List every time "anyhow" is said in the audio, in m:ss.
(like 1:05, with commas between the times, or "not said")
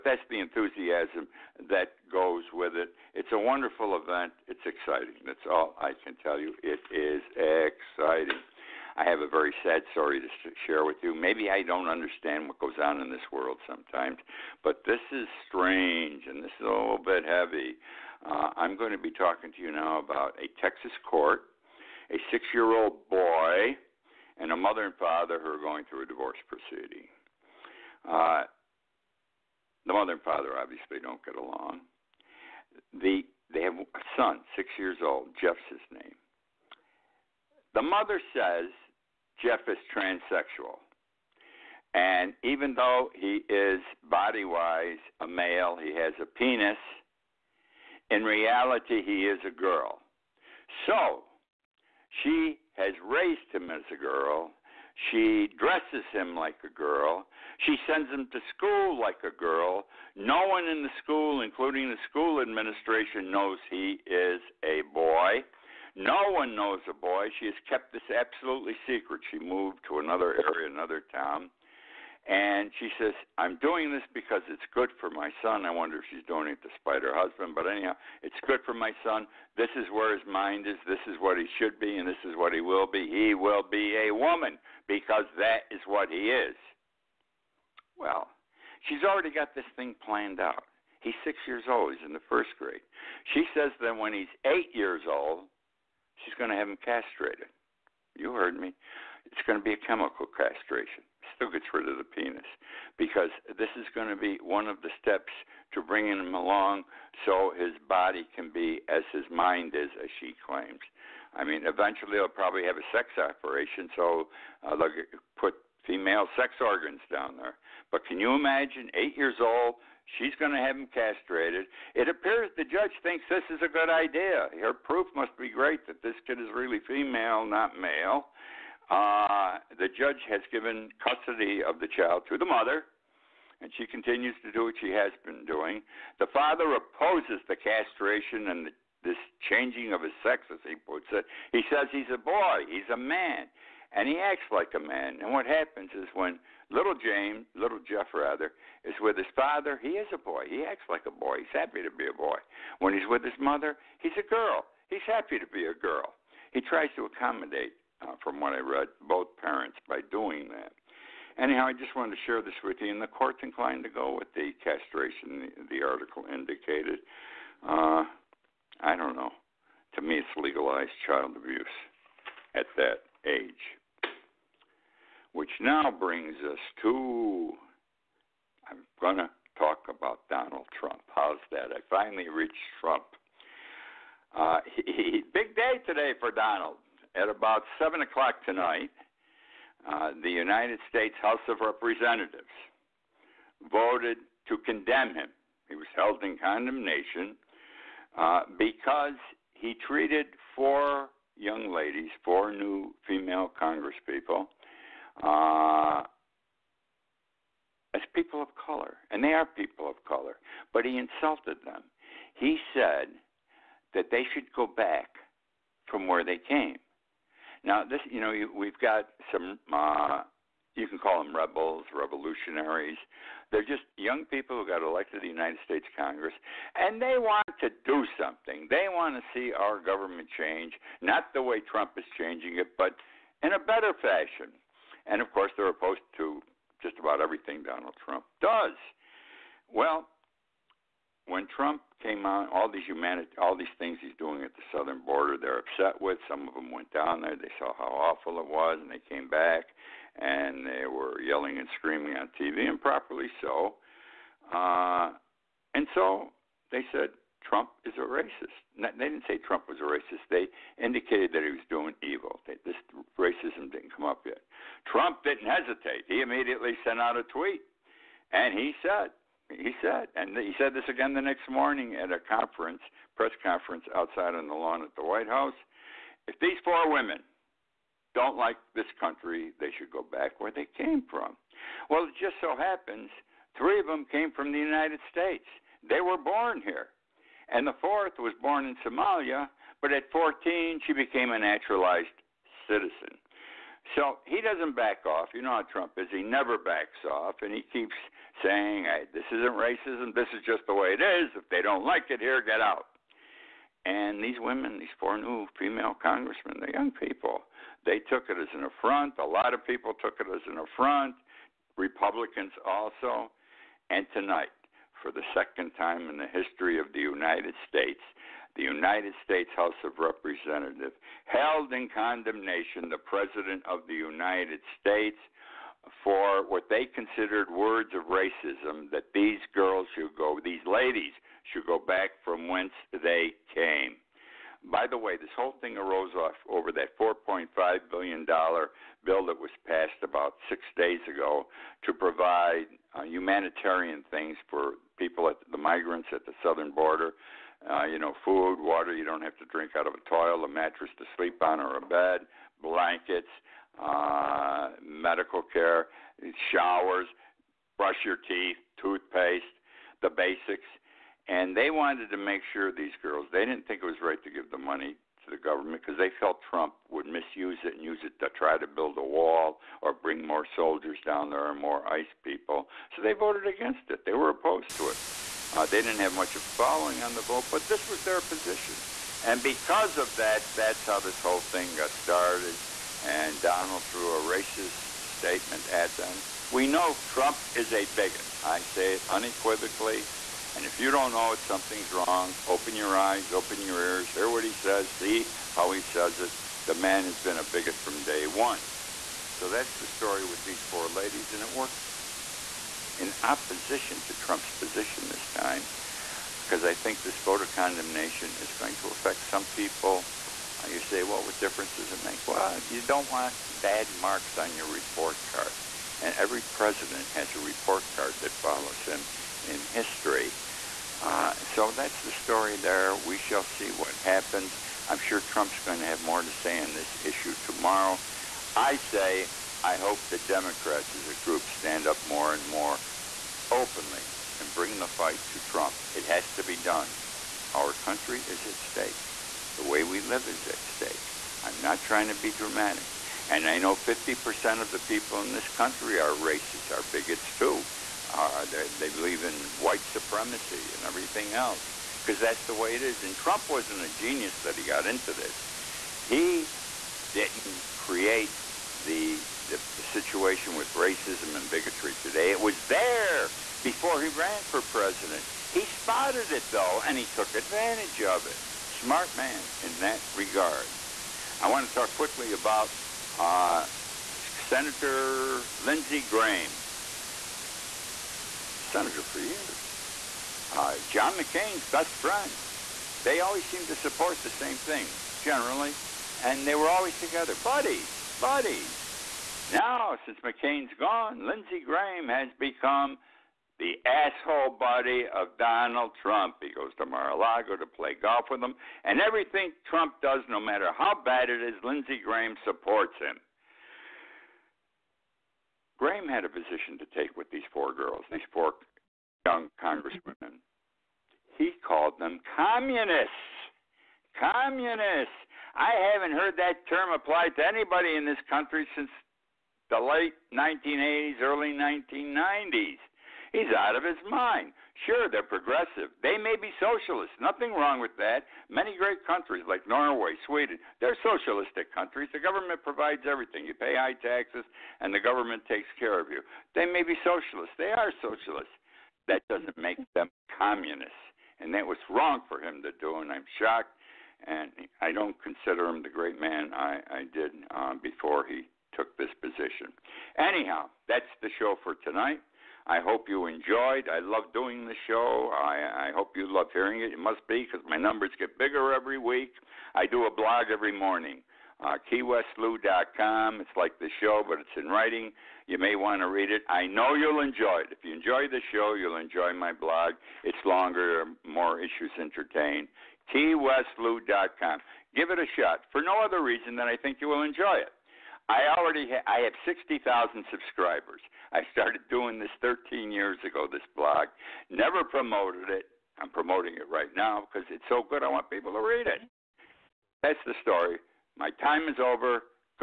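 1:17, 2:41, 9:10.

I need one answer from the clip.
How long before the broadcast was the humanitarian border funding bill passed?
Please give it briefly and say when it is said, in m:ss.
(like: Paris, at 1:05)
about six days, at 5:40.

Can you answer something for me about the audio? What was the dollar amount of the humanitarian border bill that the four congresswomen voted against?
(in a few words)
$4.5 billion.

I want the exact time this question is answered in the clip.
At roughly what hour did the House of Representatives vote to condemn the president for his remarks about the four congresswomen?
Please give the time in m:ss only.
3:07.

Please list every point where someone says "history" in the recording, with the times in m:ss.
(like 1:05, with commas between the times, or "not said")
5:16, 6:59.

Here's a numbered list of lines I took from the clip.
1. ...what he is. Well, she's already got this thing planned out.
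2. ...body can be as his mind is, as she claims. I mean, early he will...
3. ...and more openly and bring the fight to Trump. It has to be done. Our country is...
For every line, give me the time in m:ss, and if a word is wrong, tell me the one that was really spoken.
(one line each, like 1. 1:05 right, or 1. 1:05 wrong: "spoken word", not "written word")
1. 1:25 right
2. 1:47 wrong: "eventually", not "early"
3. 7:12 right.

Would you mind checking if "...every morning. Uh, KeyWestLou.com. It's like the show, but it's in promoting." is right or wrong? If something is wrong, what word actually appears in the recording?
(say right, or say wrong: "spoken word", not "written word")
wrong: "writing", not "promoting".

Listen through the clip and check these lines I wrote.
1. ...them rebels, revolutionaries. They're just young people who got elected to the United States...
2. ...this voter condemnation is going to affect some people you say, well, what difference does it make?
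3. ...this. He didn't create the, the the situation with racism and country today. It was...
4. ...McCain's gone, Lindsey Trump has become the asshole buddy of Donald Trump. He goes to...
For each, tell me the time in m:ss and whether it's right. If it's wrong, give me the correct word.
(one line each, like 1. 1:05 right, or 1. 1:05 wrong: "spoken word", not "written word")
1. 3:41 right
2. 6:47 right
3. 7:35 wrong: "bigotry", not "country"
4. 8:10 wrong: "Graham", not "Trump".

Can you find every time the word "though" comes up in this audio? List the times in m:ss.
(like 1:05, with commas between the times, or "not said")
0:42, 7:46.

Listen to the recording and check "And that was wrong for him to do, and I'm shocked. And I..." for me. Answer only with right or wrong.
right.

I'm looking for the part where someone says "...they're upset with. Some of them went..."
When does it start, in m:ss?
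4:05.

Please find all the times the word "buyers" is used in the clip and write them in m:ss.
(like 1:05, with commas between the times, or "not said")
not said.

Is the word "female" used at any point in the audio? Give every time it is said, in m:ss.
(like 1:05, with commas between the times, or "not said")
1:55, 2:06, 3:23, 5:05.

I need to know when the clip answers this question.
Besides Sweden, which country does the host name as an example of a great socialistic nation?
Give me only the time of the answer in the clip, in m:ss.
8:49.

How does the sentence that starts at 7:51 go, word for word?
I want to talk quickly about uh, Senator Lindsey Graham, senator for years.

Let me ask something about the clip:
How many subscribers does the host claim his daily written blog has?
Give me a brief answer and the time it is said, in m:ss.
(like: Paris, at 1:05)
60,000, at 9:39.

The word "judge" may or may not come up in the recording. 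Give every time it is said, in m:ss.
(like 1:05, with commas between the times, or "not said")
2:02, 2:09.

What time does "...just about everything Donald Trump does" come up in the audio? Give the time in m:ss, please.
3:56.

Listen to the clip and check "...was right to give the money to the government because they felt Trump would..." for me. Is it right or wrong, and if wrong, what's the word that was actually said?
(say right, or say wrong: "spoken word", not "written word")
right.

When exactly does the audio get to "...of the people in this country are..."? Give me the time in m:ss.
7:24.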